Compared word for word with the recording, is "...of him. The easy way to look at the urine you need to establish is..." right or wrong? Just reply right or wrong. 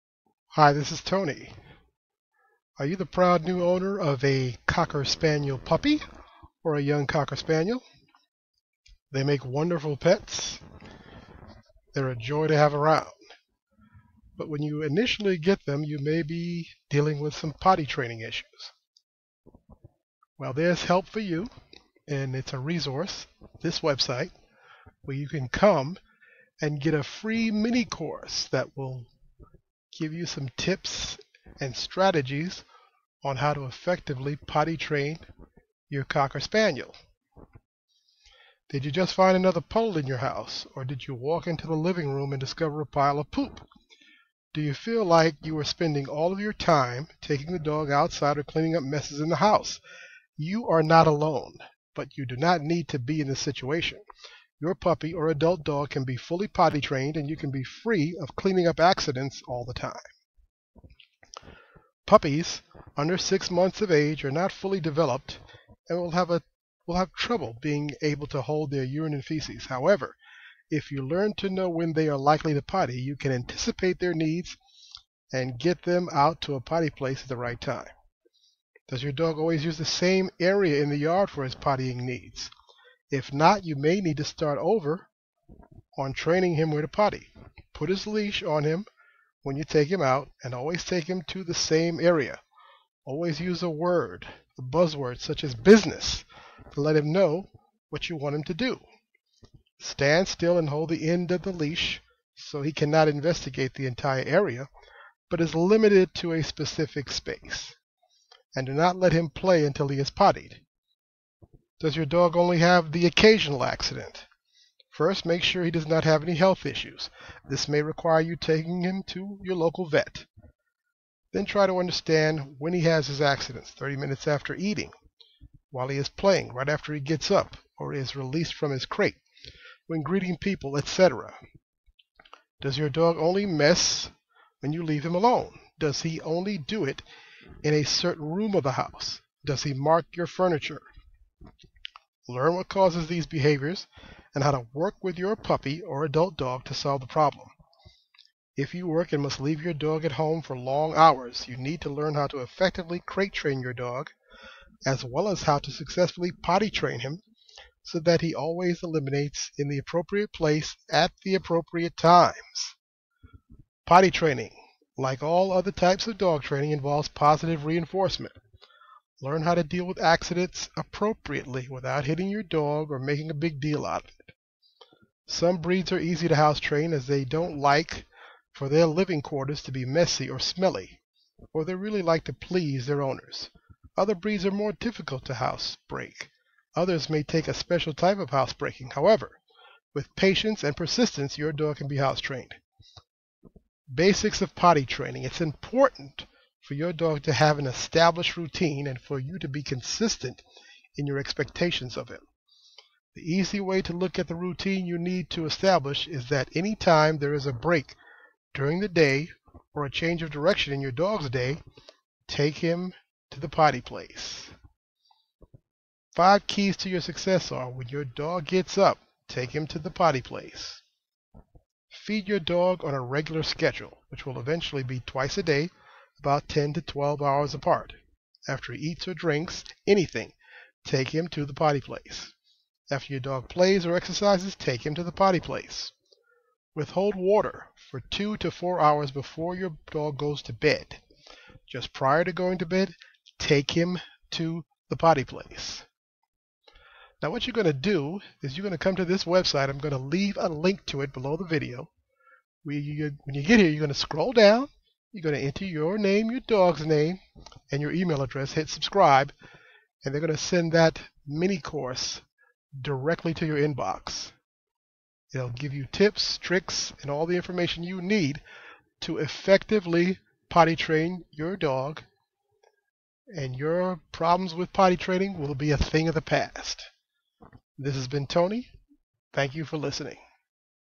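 wrong.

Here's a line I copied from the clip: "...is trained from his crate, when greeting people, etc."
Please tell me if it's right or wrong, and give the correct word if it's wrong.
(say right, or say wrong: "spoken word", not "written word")
wrong: "released", not "trained".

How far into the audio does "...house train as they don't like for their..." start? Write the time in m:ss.
2:56.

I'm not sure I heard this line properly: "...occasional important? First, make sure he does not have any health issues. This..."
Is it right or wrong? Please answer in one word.
wrong.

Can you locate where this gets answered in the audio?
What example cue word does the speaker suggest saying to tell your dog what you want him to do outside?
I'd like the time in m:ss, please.
1:35.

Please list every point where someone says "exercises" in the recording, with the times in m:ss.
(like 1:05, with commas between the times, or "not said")
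3:53.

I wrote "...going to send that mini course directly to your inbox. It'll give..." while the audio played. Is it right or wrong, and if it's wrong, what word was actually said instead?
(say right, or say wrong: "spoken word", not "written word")
right.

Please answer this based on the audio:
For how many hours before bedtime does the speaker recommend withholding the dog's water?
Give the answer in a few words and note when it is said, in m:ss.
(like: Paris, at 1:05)
2 to 4 hours, at 3:58.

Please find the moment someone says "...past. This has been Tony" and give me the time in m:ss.
4:36.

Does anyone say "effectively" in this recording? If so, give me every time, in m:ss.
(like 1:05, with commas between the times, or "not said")
0:33, 2:32, 4:29.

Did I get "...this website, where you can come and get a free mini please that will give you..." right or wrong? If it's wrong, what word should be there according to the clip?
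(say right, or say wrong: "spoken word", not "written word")
wrong: "course", not "please".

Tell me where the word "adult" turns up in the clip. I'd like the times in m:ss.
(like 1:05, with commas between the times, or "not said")
0:55, 2:26.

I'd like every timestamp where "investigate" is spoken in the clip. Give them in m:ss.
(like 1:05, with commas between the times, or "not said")
1:43.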